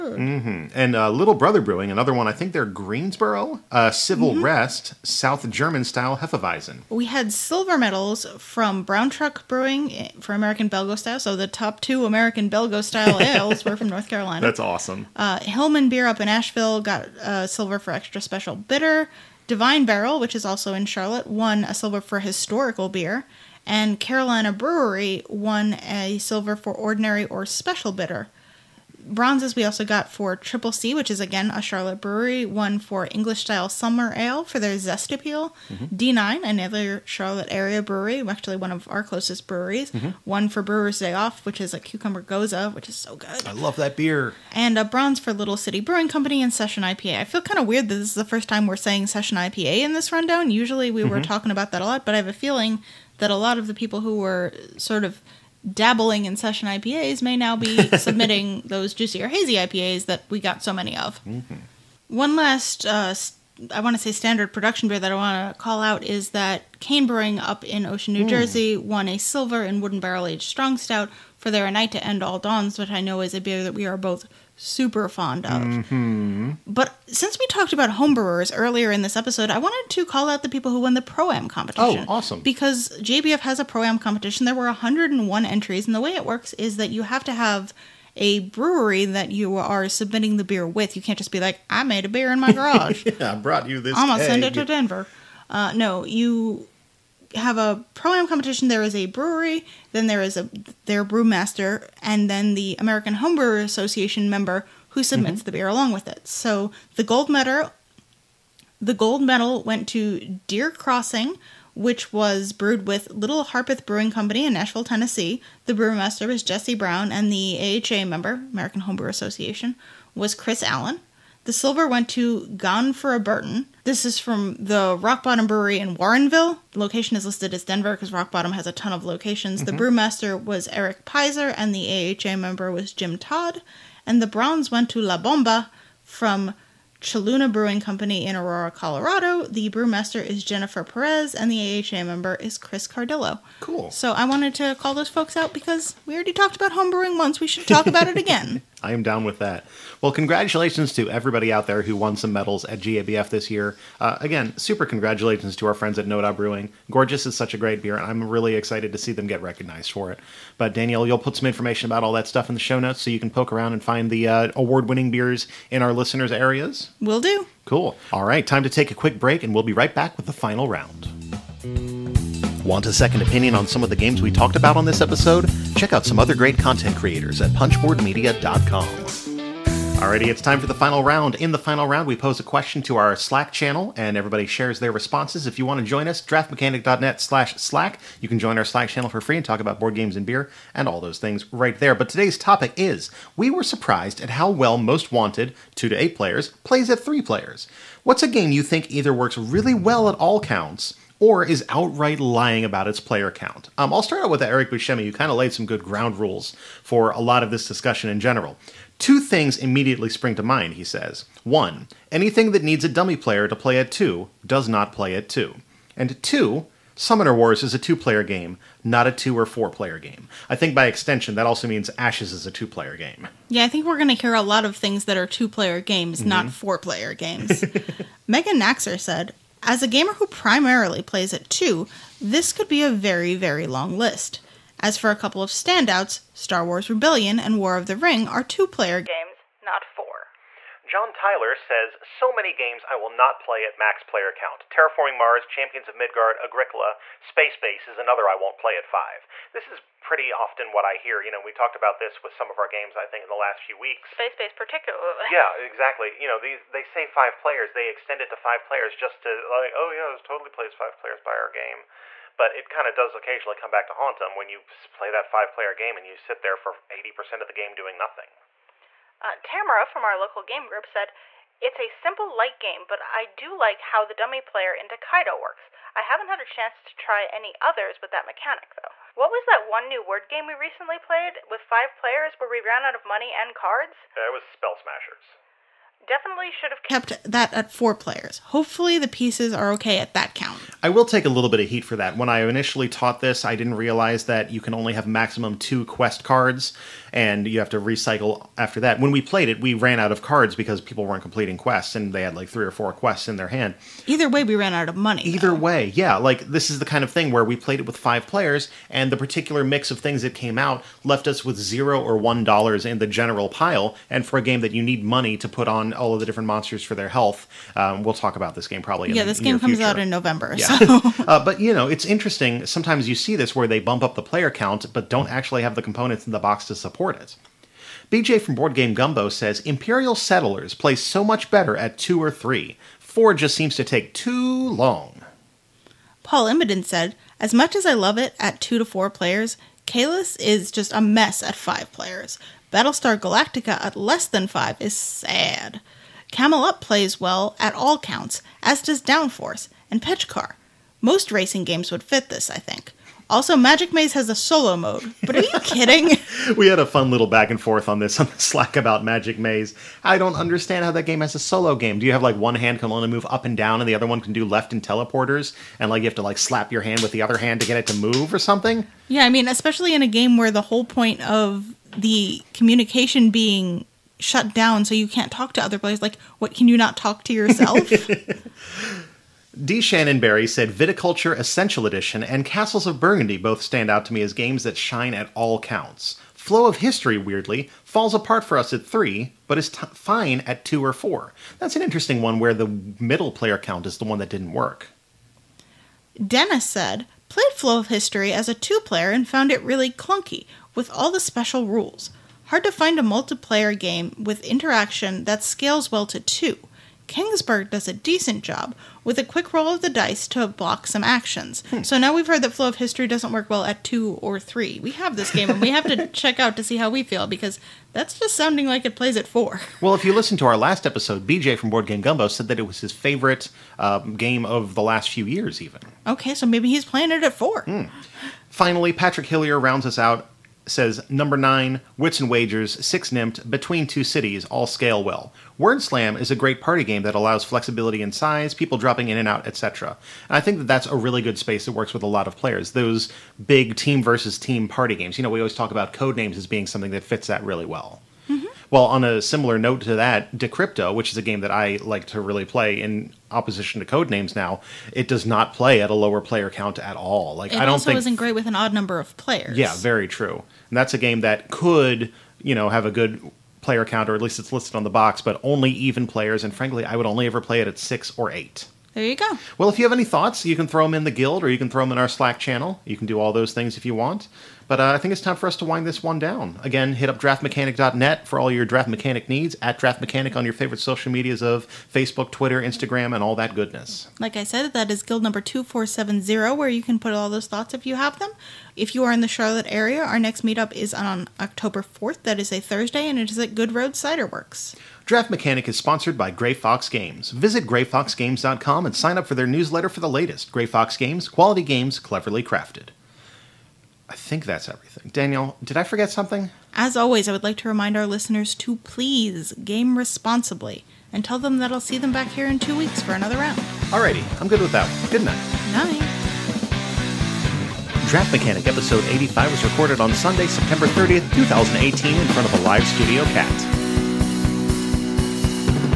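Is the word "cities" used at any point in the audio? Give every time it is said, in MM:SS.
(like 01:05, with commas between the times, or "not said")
07:14.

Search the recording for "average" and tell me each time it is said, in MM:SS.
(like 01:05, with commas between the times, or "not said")
not said.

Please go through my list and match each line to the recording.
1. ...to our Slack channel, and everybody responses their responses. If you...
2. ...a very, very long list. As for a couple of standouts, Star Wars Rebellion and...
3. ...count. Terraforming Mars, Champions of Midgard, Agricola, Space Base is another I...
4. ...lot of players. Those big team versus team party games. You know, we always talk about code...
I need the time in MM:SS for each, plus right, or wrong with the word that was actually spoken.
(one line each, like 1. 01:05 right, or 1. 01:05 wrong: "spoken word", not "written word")
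1. 03:02 wrong: "shares", not "responses"
2. 03:52 right
3. 04:04 right
4. 07:22 right.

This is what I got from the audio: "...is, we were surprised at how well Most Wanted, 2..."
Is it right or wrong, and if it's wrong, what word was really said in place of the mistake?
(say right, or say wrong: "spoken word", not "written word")
right.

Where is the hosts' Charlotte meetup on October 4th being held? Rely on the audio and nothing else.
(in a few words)
Goodroad Cider Works.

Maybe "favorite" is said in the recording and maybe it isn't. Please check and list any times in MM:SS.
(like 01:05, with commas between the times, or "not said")
07:02, 08:00.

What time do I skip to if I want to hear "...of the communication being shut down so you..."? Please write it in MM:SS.
06:11.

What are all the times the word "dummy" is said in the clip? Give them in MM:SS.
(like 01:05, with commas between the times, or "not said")
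03:32, 04:34.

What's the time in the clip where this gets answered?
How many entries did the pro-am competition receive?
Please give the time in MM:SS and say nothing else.
01:24.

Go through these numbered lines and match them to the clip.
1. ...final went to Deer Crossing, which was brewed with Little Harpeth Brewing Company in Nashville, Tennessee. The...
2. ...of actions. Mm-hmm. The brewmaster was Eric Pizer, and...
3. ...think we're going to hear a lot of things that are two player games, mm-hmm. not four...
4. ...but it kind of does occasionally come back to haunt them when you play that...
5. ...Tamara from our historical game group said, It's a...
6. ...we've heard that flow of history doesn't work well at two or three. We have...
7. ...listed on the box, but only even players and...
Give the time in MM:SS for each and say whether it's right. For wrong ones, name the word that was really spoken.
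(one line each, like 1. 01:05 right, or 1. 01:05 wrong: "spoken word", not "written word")
1. 01:49 wrong: "medal", not "final"
2. 02:08 wrong: "locations", not "actions"
3. 03:43 right
4. 04:22 right
5. 04:29 wrong: "local", not "historical"
6. 06:52 right
7. 07:44 right.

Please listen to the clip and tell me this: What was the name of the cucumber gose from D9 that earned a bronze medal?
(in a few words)
Brewer's Day Off.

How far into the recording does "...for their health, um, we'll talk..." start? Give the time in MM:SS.
05:16.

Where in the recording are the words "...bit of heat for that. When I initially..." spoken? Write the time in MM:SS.
04:51.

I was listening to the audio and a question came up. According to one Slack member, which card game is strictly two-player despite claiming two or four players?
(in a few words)
Summoner Wars.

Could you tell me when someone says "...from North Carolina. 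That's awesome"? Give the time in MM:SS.
00:13.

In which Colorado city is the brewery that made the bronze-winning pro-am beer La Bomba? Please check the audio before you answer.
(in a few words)
Aurora.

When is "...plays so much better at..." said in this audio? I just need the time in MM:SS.
05:30.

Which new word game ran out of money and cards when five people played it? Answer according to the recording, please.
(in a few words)
Spell Smashers.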